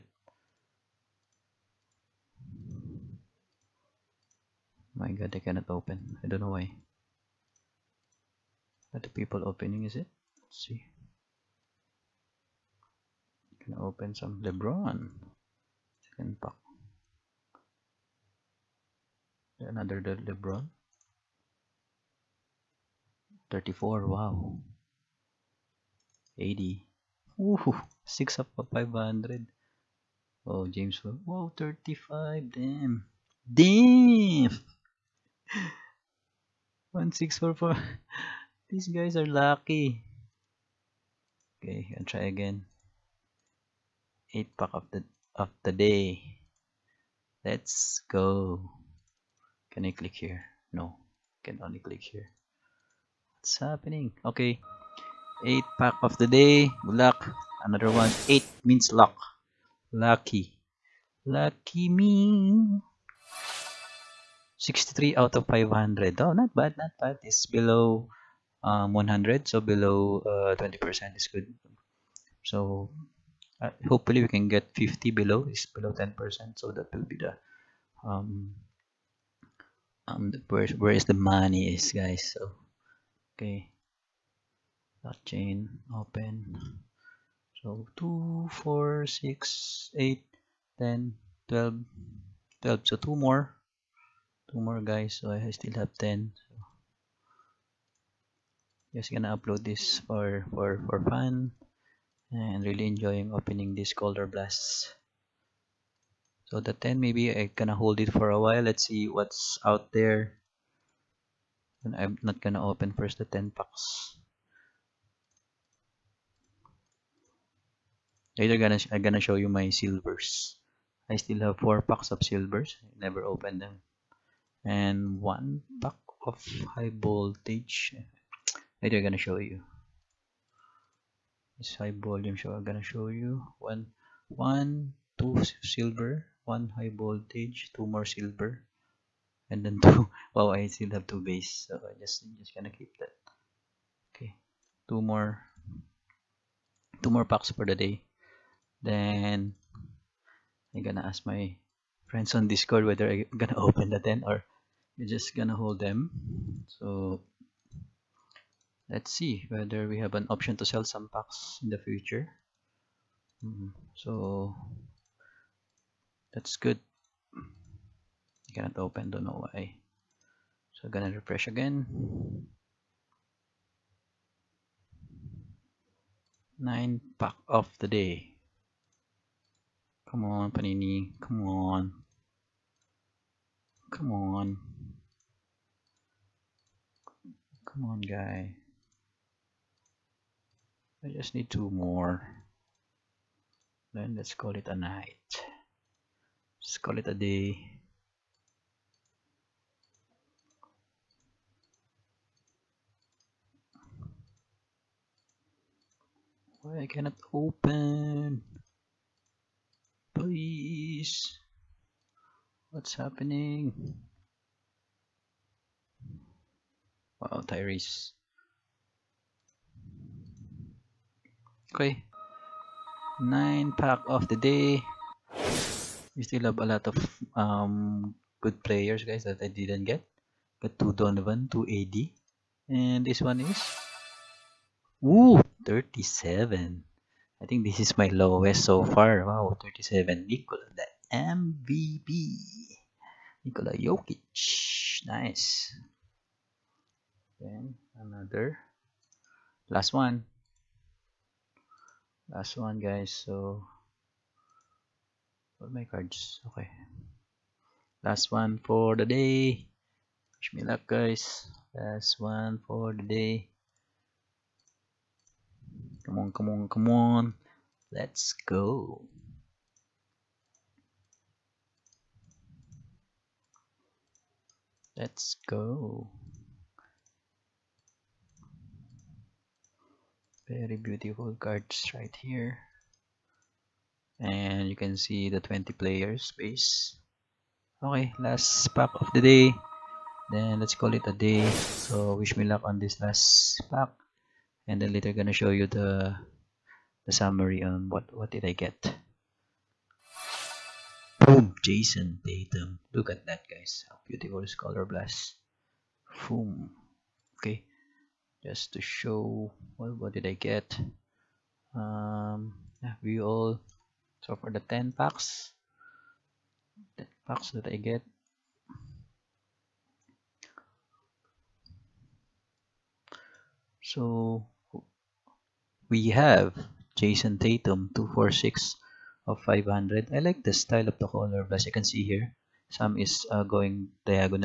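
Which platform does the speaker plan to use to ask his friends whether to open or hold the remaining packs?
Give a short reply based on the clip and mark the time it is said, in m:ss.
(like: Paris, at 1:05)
Discord, at 2:32.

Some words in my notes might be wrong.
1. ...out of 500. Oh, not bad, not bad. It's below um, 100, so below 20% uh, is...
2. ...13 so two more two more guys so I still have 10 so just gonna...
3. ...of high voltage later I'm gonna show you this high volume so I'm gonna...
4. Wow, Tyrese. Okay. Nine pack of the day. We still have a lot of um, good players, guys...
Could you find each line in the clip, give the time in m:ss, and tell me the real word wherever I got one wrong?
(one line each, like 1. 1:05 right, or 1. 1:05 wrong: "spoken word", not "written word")
1. 1:05 right
2. 1:32 wrong: "12", not "13"
3. 2:06 right
4. 3:37 right.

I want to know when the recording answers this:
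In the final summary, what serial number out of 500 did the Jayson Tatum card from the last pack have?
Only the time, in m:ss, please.
5:27.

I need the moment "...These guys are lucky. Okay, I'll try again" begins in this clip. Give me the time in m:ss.
0:38.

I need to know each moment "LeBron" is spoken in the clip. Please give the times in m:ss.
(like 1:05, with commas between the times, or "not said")
0:14, 0:20.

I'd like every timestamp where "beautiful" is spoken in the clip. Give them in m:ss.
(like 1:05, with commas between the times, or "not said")
4:40, 5:04.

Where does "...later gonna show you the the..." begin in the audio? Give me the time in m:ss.
4:54.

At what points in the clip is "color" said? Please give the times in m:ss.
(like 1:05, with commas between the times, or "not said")
1:43, 5:04, 5:31.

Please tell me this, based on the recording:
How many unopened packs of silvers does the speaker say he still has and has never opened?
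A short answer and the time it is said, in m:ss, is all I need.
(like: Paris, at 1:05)
4, at 2:01.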